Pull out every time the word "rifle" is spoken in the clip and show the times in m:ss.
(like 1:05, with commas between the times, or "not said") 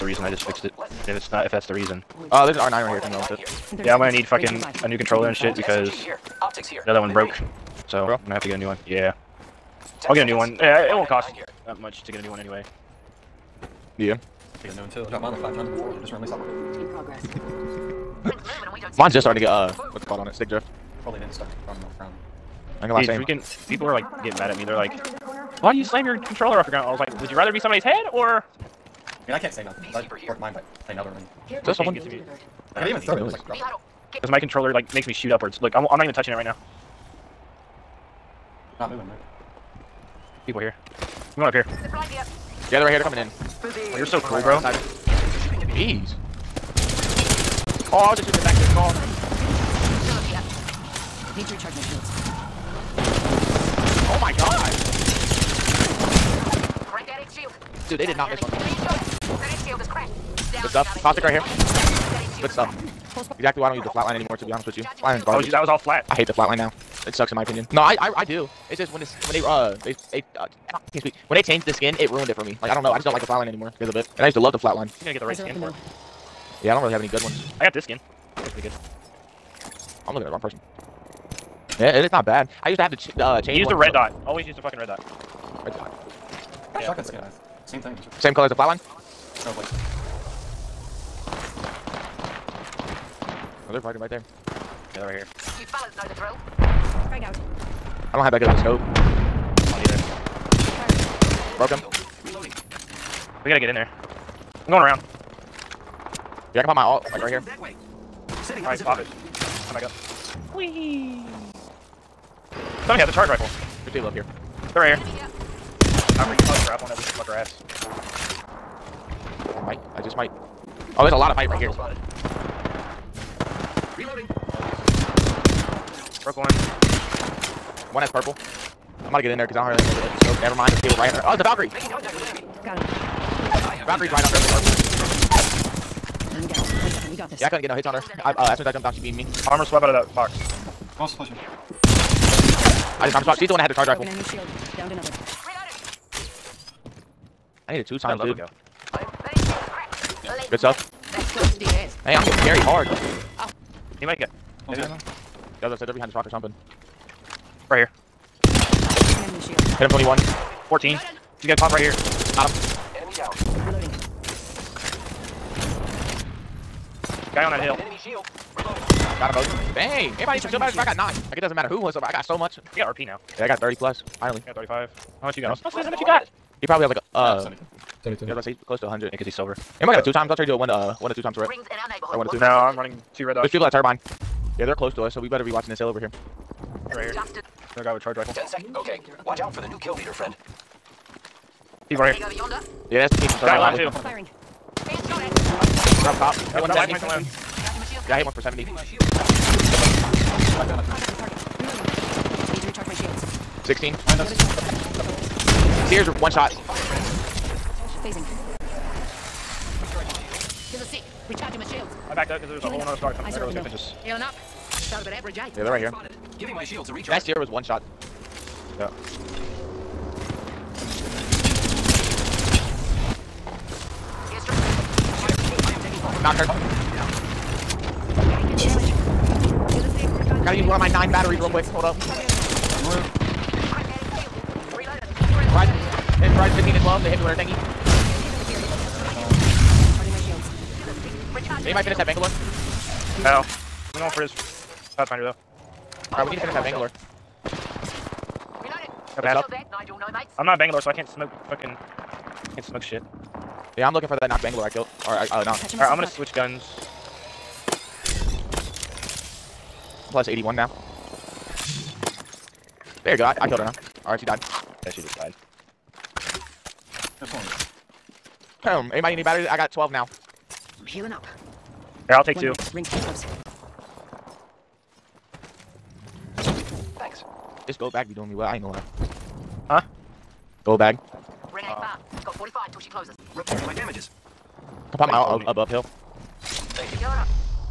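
1:53, 2:23, 3:08.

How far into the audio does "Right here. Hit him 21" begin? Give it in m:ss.
2:37.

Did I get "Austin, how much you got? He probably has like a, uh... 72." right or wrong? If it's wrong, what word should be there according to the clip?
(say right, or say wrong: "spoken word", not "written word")
right.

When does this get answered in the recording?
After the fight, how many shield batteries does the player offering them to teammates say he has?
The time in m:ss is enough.
4:29.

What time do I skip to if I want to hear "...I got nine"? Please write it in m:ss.
2:50.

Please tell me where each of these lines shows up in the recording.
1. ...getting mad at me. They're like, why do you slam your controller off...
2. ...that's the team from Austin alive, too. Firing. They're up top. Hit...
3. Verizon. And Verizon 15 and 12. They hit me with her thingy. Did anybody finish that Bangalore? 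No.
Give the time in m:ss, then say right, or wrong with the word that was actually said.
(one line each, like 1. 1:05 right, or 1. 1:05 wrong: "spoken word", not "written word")
1. 0:24 right
2. 3:13 wrong: "Guy", not "Austin"
3. 3:51 right.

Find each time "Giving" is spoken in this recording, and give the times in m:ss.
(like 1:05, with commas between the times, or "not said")
3:36.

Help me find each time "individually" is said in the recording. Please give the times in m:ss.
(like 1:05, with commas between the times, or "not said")
not said.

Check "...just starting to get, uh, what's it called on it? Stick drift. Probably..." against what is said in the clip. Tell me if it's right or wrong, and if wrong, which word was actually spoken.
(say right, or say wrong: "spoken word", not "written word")
right.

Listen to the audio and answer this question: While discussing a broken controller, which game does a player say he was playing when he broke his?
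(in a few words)
Elden Ring.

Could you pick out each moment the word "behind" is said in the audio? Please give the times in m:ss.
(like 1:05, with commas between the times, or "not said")
2:35, 3:23.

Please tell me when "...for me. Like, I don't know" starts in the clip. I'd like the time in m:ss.
1:12.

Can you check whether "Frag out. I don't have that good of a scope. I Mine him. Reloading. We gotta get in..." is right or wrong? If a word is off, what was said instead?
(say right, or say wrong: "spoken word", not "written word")
wrong: "Broke", not "Mine".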